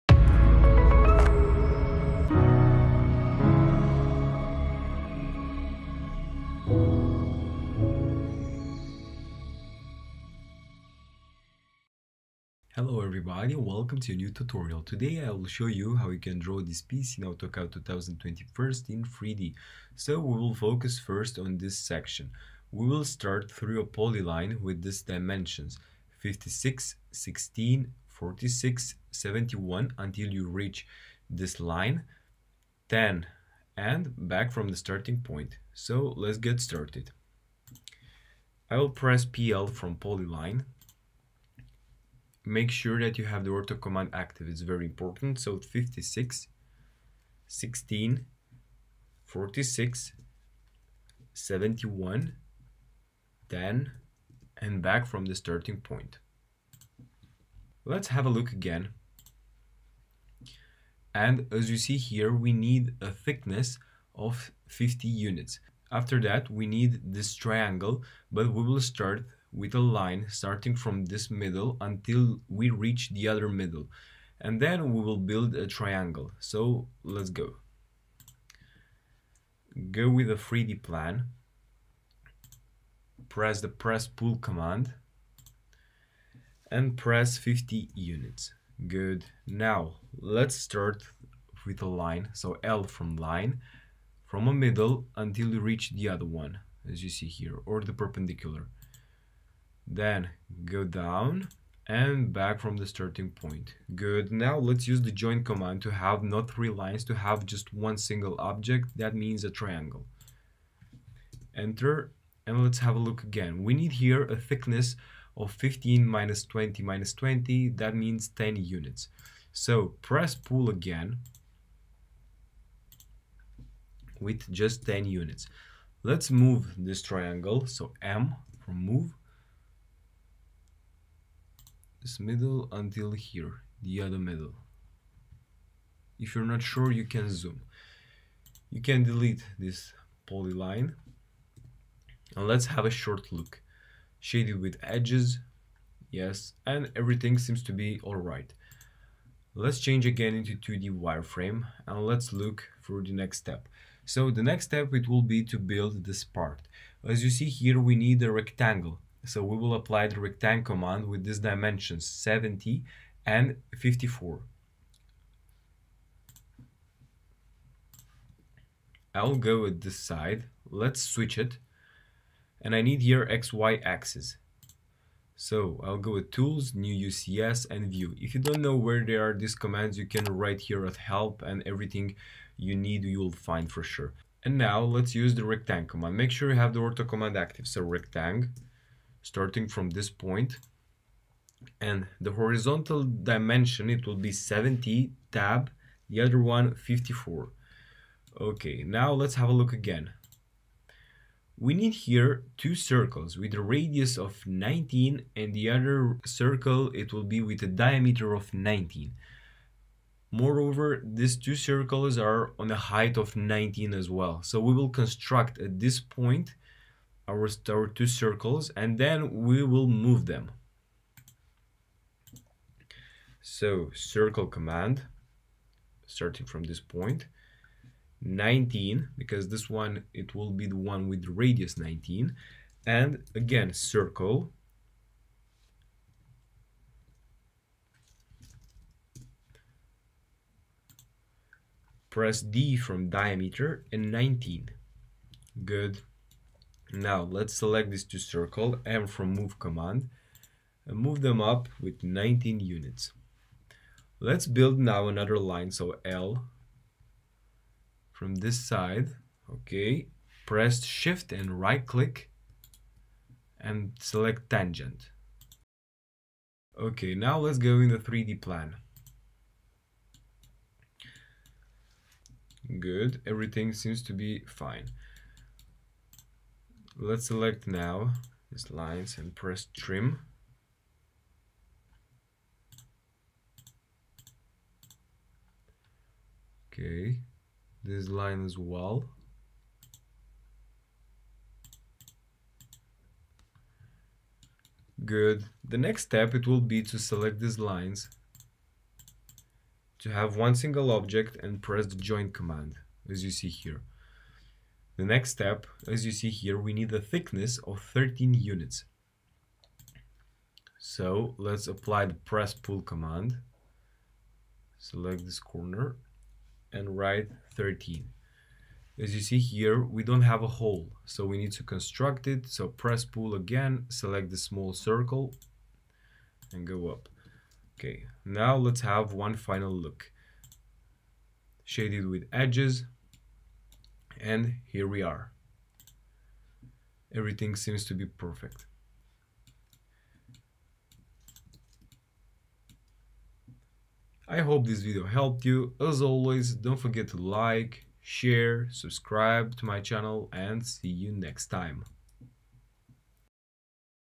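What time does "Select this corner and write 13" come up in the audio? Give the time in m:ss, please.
5:14.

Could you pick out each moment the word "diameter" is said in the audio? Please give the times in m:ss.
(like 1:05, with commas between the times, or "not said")
3:27, 4:03.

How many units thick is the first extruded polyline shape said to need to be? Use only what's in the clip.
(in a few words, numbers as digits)
50.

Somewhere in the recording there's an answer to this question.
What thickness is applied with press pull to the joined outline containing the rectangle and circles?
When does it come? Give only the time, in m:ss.
5:07.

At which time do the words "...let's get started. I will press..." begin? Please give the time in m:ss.
0:36.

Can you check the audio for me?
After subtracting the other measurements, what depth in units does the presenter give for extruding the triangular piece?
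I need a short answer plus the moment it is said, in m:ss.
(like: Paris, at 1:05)
10, at 1:57.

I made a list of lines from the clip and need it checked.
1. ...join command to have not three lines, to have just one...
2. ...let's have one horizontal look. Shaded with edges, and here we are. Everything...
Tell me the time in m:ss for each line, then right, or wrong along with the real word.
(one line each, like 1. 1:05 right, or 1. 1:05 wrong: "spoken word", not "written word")
1. 1:45 right
2. 5:28 wrong: "final", not "horizontal".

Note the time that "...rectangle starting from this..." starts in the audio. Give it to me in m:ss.
3:07.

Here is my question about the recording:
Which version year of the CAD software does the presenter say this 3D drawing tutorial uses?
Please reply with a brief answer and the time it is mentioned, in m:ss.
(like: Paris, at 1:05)
2021, at 0:17.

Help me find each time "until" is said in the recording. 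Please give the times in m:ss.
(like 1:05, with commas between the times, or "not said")
0:29, 1:11, 1:35, 2:12.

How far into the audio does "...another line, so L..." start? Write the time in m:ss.
4:15.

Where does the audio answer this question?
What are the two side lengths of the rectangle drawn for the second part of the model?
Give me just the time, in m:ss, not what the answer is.
2:42.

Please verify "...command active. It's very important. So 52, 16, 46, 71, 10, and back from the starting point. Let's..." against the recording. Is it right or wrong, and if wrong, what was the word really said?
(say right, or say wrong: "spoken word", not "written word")
wrong: "56", not "52".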